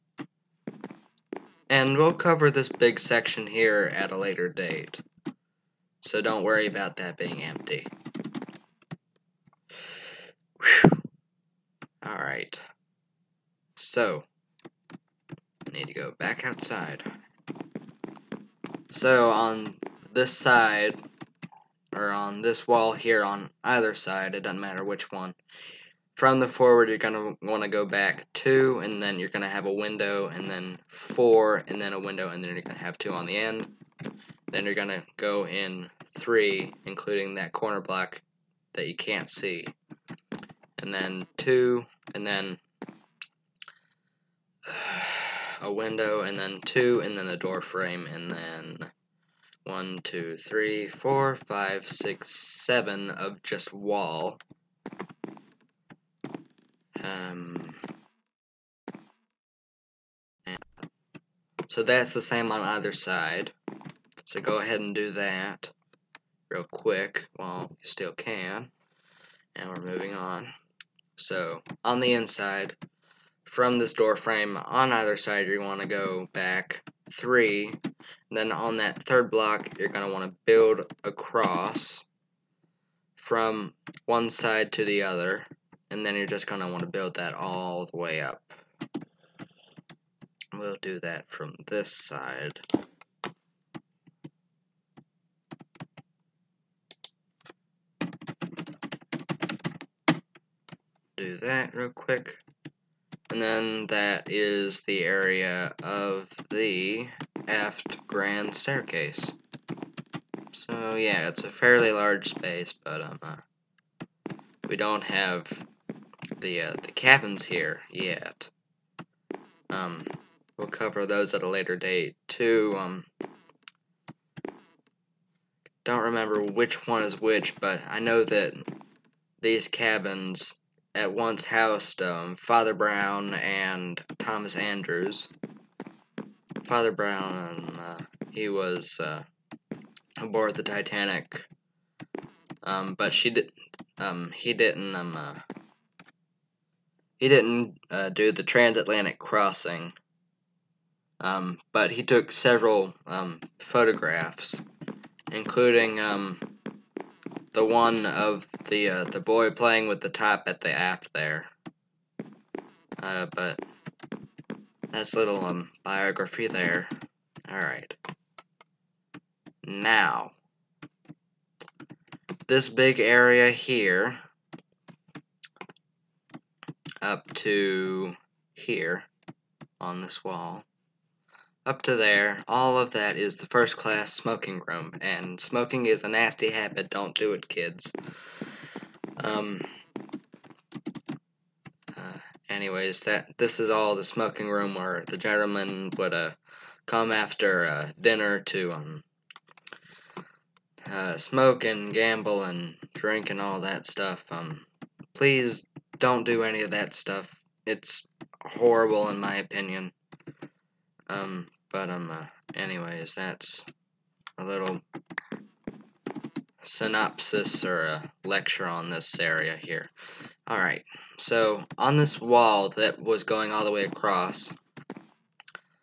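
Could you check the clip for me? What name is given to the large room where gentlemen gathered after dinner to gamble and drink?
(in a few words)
First class smoking room.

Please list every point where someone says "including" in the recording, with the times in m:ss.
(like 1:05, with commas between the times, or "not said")
0:36, 2:35.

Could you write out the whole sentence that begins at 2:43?
Uh, but that's little um biography there.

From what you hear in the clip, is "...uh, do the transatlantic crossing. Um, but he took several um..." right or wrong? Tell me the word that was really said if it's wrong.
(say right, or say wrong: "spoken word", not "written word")
right.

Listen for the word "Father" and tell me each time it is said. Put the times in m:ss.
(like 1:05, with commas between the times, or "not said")
2:12, 2:16.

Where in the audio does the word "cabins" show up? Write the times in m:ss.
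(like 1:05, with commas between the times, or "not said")
1:56, 2:09.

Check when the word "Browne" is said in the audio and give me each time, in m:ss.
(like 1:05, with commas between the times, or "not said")
2:12, 2:16.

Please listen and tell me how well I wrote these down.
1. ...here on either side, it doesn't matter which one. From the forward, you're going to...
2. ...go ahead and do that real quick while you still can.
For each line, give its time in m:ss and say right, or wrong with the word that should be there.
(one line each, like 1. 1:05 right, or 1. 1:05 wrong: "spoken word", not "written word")
1. 0:22 right
2. 1:04 right.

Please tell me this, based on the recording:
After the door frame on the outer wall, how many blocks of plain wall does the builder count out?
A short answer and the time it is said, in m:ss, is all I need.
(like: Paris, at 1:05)
7, at 0:52.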